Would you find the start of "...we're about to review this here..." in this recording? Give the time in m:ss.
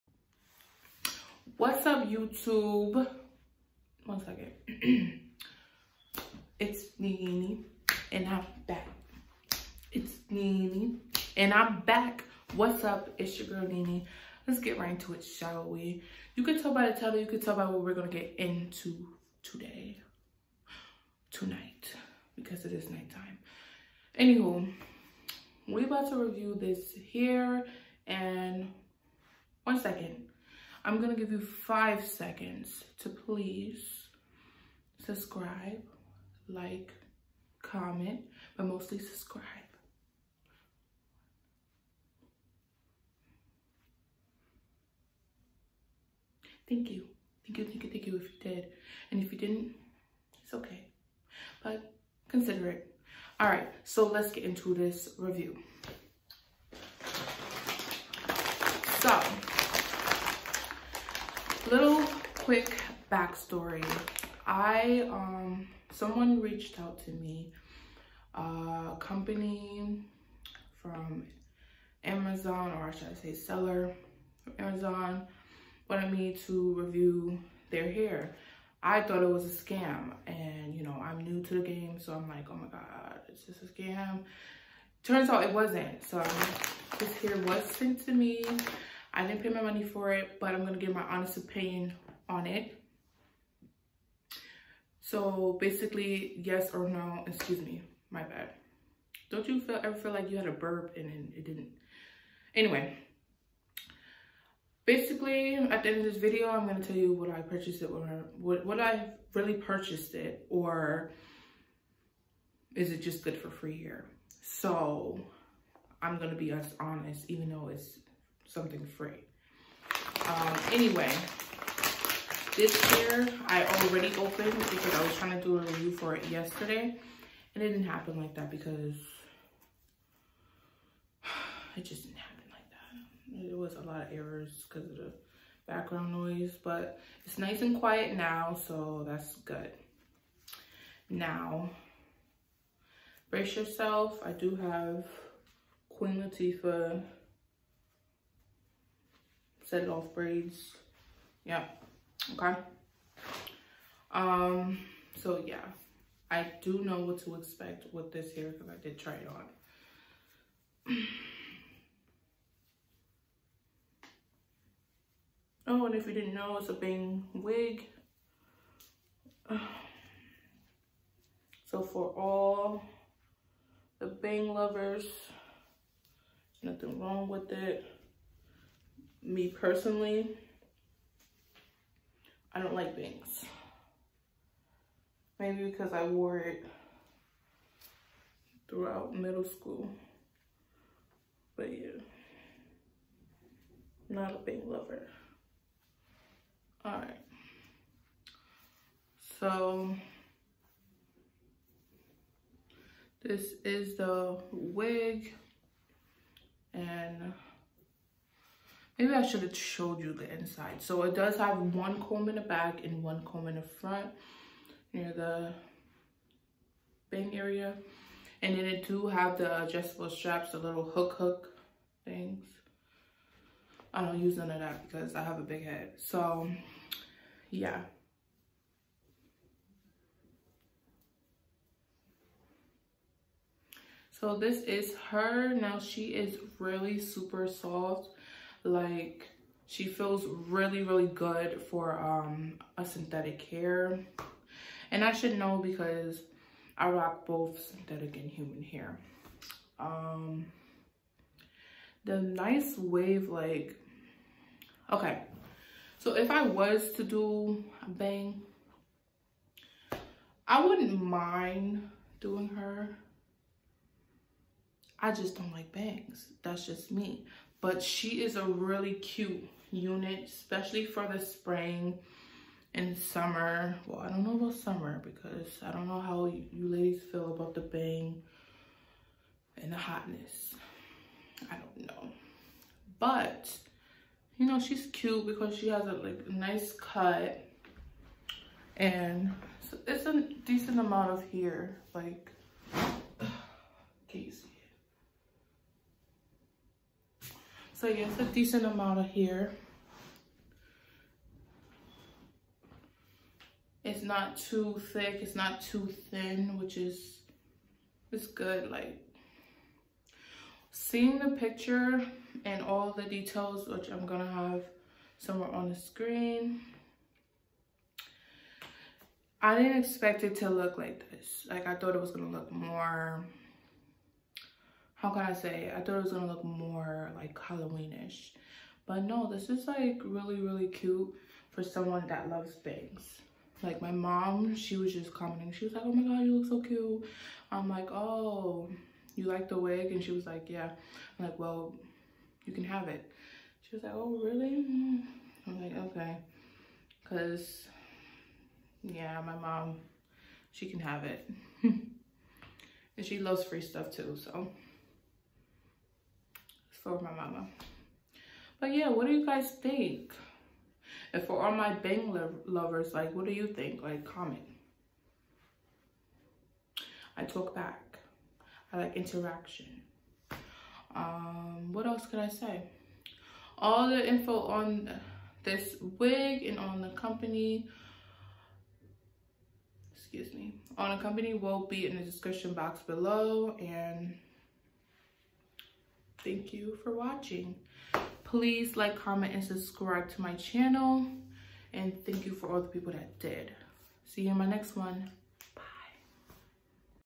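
0:25.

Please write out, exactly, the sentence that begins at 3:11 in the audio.
But yeah, not a bang lover.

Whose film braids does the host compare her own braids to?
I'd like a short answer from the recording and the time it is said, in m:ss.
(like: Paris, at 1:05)
Queen Latifah, at 2:25.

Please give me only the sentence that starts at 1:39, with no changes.
Don't you feel, ever feel like you had a burp and it didn't?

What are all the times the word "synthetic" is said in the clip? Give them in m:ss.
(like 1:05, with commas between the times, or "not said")
4:02, 4:07.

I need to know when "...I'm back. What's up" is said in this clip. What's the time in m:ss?
0:11.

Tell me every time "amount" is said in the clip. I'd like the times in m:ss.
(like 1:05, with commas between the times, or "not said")
4:50, 4:58.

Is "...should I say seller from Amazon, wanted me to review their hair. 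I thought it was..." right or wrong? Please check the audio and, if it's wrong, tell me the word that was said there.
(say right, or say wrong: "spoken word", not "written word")
right.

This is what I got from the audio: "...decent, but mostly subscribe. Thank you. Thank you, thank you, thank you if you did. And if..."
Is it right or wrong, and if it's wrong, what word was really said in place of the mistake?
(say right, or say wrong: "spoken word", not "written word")
wrong: "comment", not "decent".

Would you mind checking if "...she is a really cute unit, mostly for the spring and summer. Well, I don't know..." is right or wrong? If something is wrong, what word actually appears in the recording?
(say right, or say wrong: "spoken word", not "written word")
wrong: "especially", not "mostly".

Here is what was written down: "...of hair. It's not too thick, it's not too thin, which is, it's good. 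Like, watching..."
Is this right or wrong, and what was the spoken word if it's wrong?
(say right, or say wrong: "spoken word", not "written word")
wrong: "seeing", not "watching".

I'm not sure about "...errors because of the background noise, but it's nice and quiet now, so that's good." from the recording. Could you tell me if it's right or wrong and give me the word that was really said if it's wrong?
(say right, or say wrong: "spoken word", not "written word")
right.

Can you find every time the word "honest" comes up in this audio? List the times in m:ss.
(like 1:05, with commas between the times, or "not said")
1:31, 1:56.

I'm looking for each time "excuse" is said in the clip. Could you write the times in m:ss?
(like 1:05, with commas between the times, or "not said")
1:37, 6:19.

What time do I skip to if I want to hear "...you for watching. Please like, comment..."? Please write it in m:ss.
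6:26.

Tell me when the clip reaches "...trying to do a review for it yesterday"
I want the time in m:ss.
2:05.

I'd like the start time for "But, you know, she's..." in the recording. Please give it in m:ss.
4:42.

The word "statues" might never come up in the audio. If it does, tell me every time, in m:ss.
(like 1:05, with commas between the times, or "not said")
not said.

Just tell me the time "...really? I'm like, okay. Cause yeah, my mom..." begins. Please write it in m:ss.
5:44.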